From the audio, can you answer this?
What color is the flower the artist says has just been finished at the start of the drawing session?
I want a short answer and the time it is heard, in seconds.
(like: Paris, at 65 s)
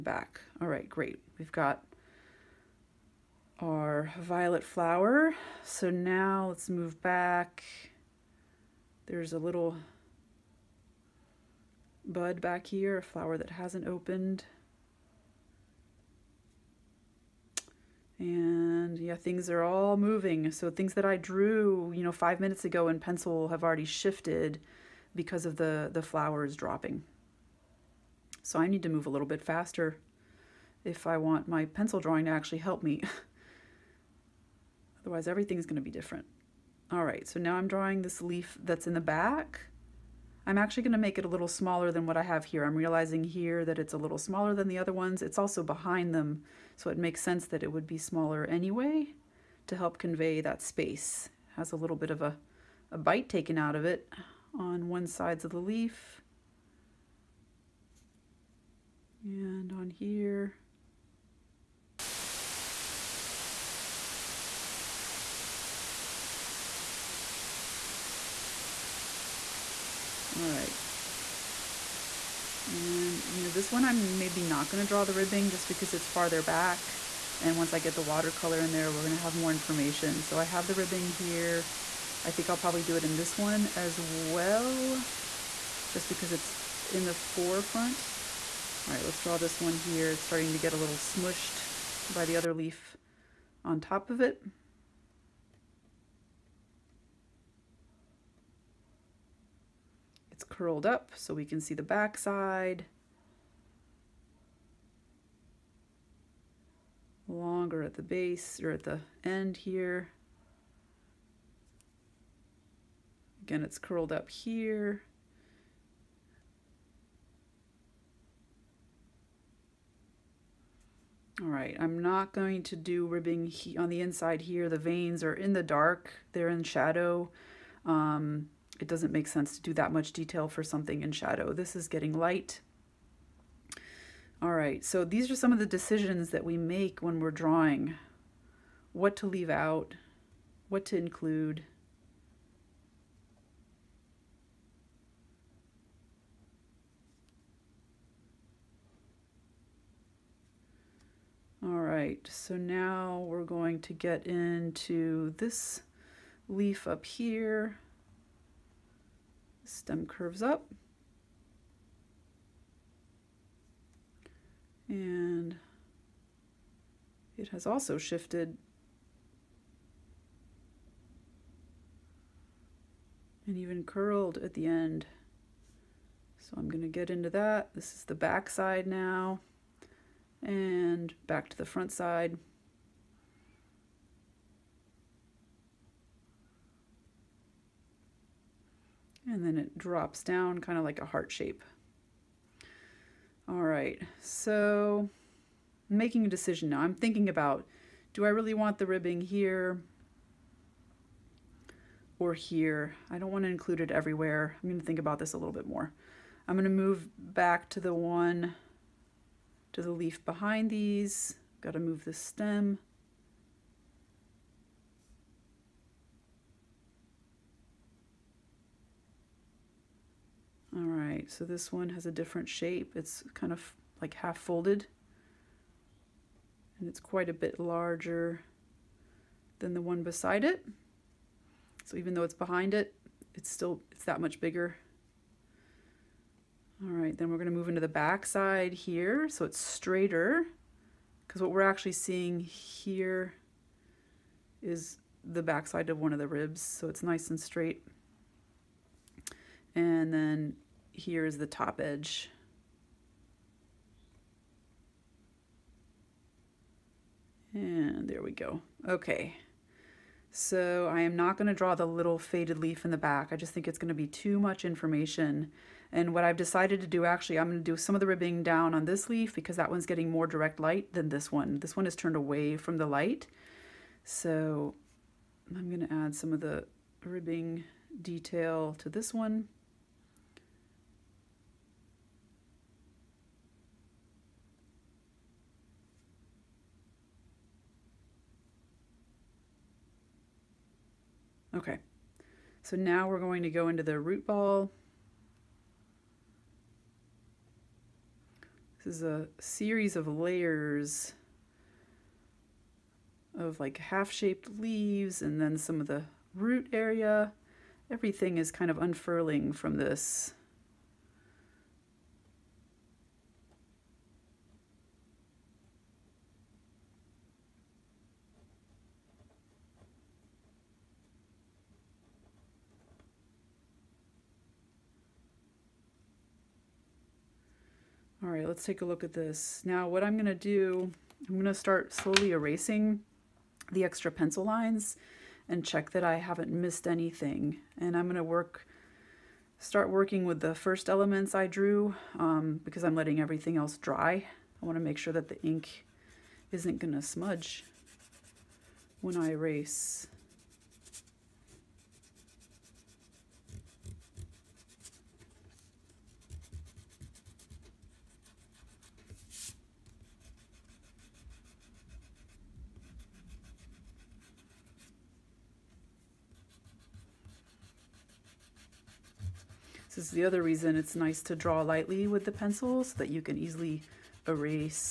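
Violet, at 4 s.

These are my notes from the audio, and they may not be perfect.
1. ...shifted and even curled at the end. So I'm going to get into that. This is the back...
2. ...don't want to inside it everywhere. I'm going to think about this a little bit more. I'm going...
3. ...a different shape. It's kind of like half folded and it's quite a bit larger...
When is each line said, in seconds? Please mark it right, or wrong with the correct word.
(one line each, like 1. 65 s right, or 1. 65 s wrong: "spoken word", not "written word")
1. 167 s right
2. 203 s wrong: "include", not "inside"
3. 222 s right.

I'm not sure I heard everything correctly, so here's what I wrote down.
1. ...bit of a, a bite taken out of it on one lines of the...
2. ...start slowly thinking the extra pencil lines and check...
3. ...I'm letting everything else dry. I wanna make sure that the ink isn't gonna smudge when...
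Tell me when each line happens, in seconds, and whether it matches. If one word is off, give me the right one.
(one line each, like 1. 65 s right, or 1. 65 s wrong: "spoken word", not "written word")
1. 51 s wrong: "sides", not "lines"
2. 331 s wrong: "erasing", not "thinking"
3. 342 s right.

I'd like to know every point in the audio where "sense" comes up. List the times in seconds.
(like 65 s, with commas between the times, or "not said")
47 s, 129 s.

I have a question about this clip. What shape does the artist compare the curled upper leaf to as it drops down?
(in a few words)
Heart shape.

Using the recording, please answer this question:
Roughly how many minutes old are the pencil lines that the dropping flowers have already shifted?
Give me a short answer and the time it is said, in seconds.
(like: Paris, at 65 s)
5, at 22 s.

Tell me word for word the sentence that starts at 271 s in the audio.
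This one is turned away from the light.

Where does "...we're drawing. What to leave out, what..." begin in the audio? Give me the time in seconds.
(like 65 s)
137 s.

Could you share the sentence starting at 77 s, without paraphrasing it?
And once I get the watercolor in there, we're going to have more information.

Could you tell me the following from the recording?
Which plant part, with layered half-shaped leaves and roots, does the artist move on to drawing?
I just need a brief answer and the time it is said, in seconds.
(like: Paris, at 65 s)
Root ball, at 293 s.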